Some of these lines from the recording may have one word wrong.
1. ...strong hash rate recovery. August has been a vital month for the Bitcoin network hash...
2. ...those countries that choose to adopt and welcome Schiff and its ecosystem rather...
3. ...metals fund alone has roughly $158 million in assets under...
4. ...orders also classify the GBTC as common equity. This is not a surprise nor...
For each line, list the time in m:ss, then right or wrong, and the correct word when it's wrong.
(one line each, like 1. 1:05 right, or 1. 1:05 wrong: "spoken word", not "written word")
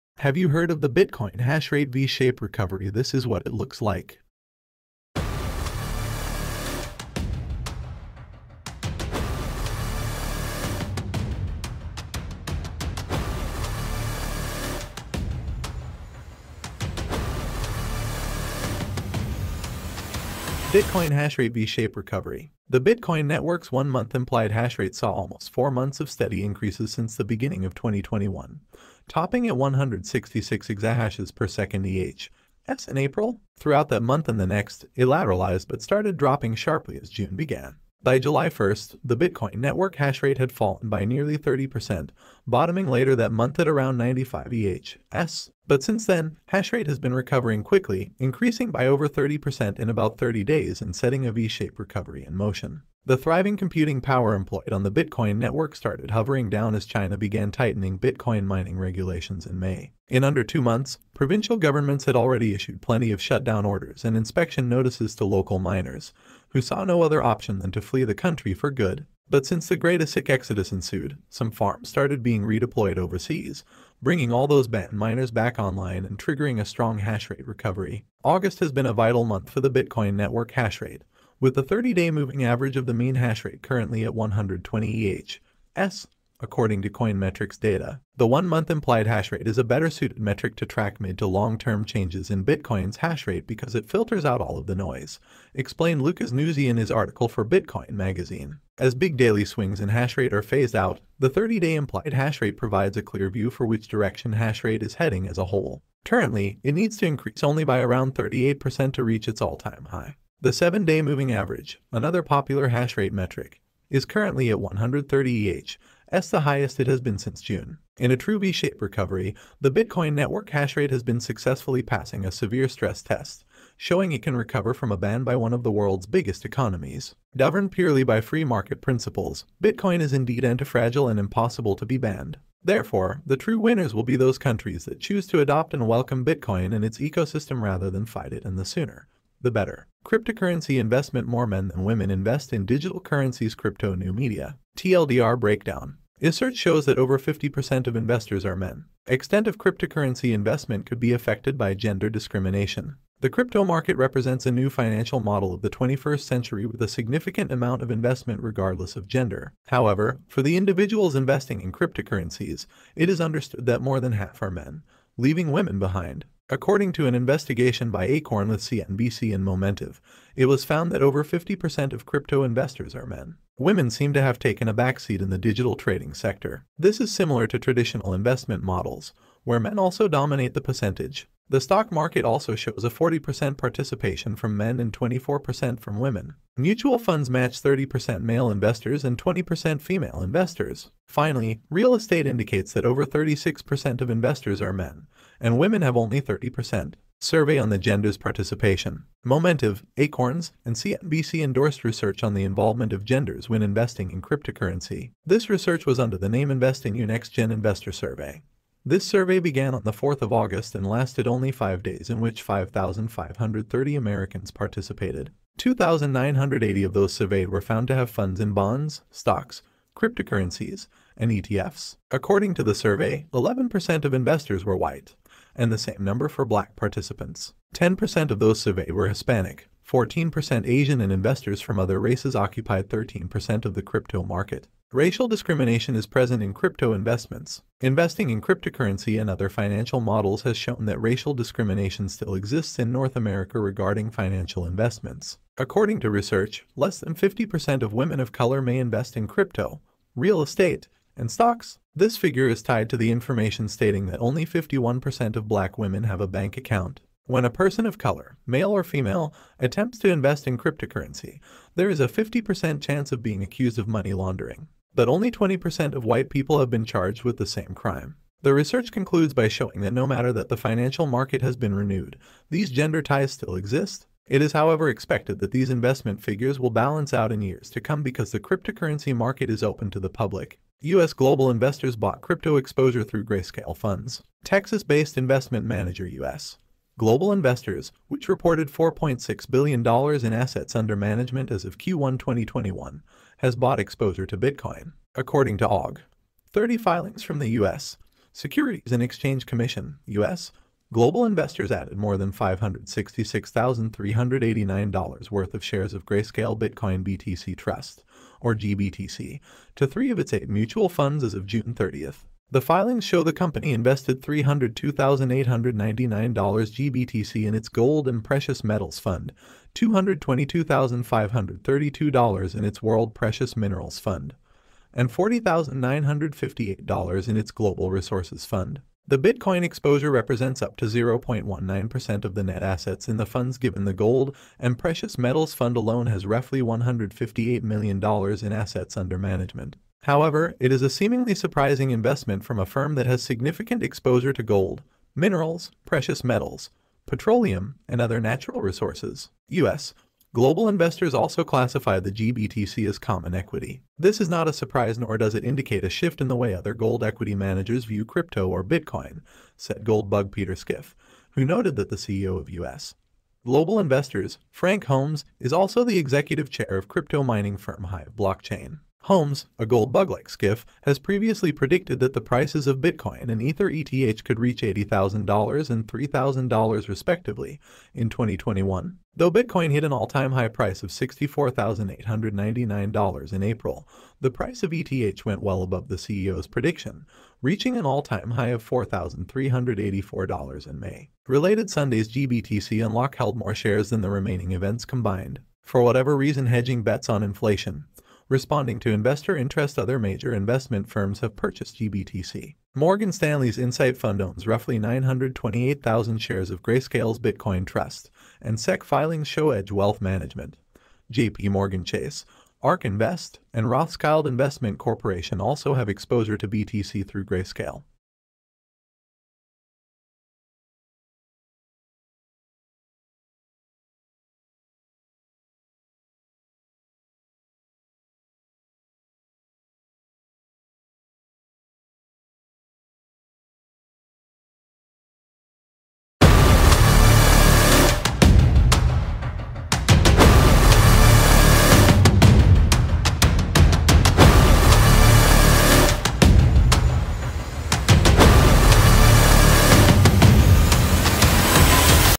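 1. 1:16 right
2. 2:14 wrong: "Bitcoin", not "Schiff"
3. 5:35 right
4. 5:50 wrong: "investors", not "orders".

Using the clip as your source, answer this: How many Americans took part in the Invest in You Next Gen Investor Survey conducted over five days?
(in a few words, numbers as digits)
5,530.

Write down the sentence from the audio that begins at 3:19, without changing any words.
Momentive, Acorns, and CNBC endorsed research on the involvement of genders when investing in cryptocurrency.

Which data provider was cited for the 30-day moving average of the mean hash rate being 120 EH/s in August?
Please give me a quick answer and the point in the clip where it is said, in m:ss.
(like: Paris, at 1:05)
Coinmetrics, at 1:26.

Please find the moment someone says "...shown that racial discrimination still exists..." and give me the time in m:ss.
4:00.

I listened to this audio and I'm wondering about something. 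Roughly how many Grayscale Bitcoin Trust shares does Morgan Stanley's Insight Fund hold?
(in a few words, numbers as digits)
928,000.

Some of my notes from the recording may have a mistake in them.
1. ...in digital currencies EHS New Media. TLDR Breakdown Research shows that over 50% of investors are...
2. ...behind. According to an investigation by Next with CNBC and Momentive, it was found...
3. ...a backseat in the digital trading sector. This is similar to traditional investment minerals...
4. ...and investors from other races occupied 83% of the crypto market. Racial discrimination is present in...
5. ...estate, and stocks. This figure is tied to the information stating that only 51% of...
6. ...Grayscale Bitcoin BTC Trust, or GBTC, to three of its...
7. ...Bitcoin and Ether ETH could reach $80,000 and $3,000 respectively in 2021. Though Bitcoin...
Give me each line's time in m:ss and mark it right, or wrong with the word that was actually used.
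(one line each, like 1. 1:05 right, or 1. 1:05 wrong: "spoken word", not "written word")
1. 2:22 wrong: "Crypto", not "EHS"
2. 2:45 wrong: "Acorn", not "Next"
3. 2:54 wrong: "models", not "minerals"
4. 3:51 wrong: "13", not "83"
5. 4:10 right
6. 5:06 right
7. 6:12 right.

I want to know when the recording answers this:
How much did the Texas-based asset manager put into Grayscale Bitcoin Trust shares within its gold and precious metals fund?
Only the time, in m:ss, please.
5:14.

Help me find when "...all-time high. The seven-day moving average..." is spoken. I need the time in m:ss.
1:49.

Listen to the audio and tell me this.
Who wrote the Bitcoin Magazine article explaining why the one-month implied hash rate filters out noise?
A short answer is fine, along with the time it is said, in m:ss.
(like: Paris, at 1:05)
Lucas Nuzzi, at 1:36.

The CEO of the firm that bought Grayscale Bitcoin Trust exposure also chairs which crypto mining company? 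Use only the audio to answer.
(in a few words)
Hive Blockchain.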